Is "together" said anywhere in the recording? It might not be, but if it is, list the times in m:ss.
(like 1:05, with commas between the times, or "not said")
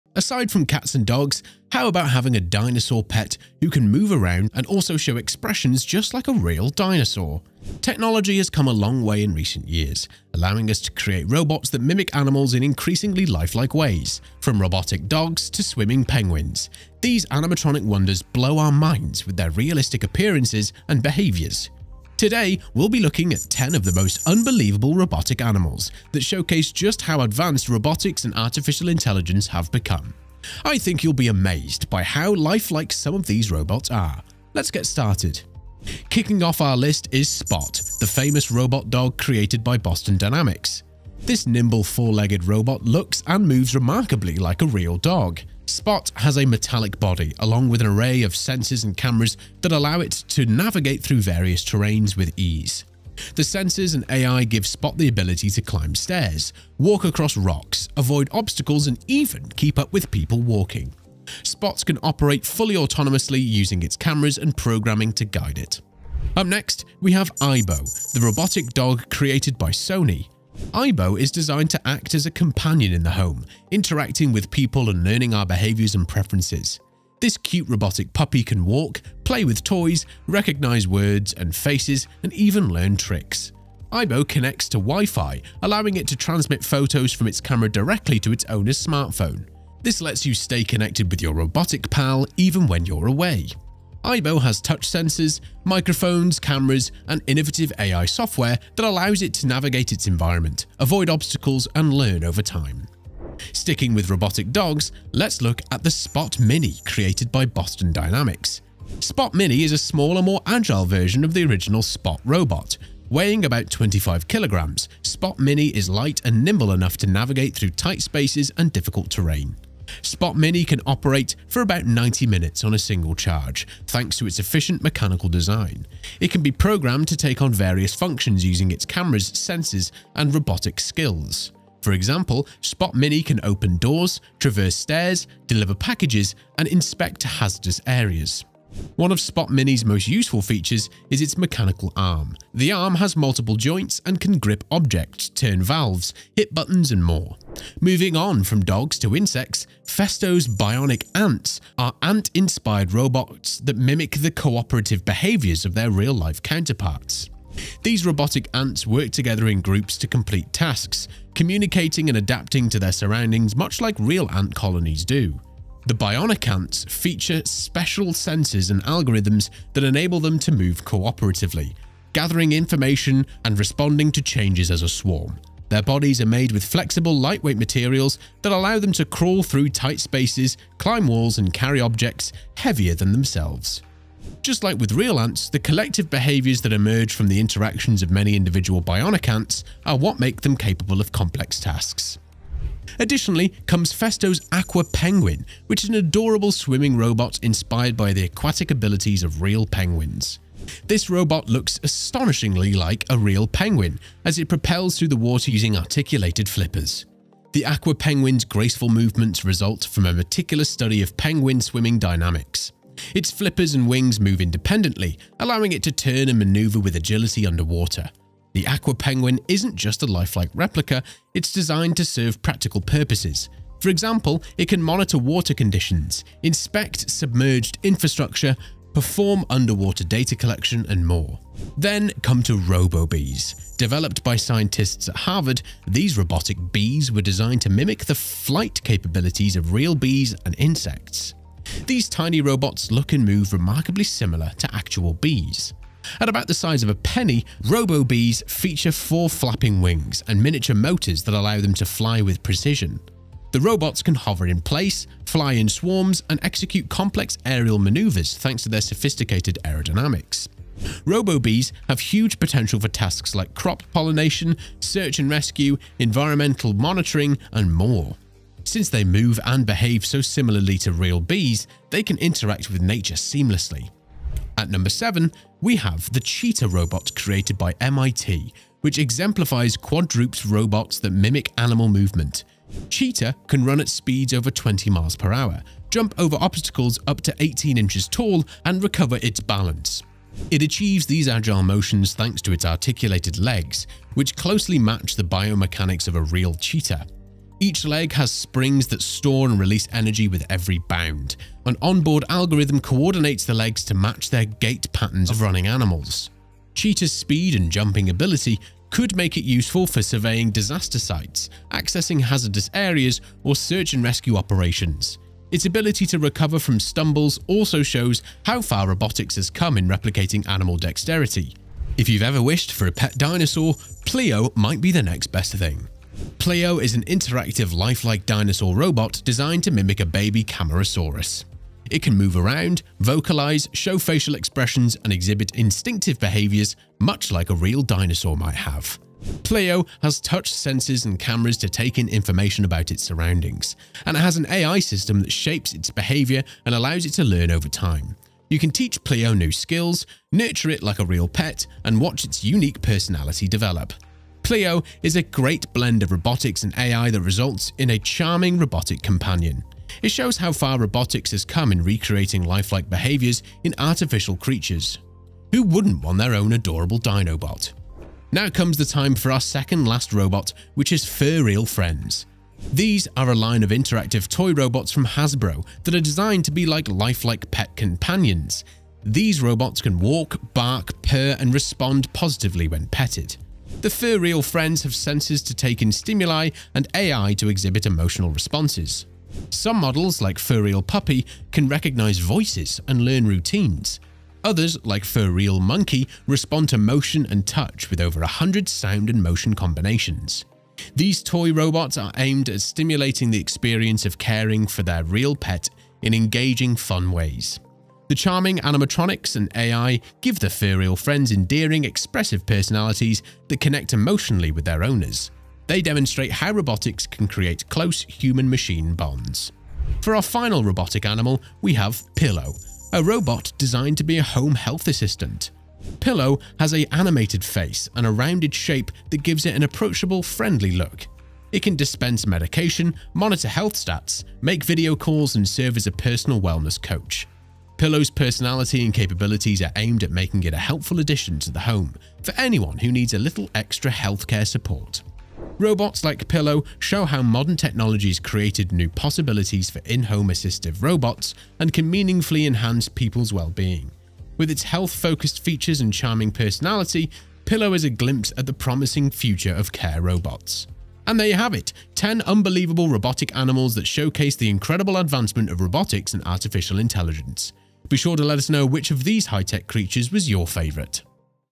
2:39.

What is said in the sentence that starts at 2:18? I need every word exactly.
One of Spot Mini's most useful features is its mechanical arm.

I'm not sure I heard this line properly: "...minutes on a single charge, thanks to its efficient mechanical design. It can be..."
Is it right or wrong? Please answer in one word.
right.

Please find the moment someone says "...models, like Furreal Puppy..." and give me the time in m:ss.
6:29.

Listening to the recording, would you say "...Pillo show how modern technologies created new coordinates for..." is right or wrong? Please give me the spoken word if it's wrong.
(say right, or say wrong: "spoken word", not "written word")
wrong: "possibilities", not "coordinates".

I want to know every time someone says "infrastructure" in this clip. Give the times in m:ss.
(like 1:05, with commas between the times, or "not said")
3:47.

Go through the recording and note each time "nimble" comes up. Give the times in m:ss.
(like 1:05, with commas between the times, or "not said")
0:41, 1:56.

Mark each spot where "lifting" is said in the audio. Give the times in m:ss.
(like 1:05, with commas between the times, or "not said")
not said.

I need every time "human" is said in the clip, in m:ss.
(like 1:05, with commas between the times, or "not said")
6:58.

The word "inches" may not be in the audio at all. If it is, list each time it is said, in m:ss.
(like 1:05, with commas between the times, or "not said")
4:47.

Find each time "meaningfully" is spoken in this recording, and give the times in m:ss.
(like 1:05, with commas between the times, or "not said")
7:31.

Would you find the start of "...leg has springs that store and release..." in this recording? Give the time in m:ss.
4:57.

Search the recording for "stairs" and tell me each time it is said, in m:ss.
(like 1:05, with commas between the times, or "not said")
0:55, 2:14.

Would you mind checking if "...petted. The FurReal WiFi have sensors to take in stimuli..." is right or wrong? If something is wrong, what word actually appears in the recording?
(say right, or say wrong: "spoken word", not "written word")
wrong: "Friends", not "WiFi".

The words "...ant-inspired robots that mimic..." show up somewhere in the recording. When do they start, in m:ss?
2:32.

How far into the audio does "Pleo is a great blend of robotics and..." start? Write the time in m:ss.
5:54.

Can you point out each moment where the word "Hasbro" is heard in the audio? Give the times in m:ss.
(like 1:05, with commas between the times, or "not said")
6:15.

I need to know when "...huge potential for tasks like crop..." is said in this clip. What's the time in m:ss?
4:21.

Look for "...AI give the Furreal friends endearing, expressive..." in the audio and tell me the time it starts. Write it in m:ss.
6:49.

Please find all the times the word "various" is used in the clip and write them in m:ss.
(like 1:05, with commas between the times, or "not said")
0:51, 2:07.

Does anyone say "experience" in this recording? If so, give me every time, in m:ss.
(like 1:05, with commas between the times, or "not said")
6:43.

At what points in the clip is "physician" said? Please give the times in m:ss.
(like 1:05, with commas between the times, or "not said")
not said.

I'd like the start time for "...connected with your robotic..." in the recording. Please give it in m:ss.
1:30.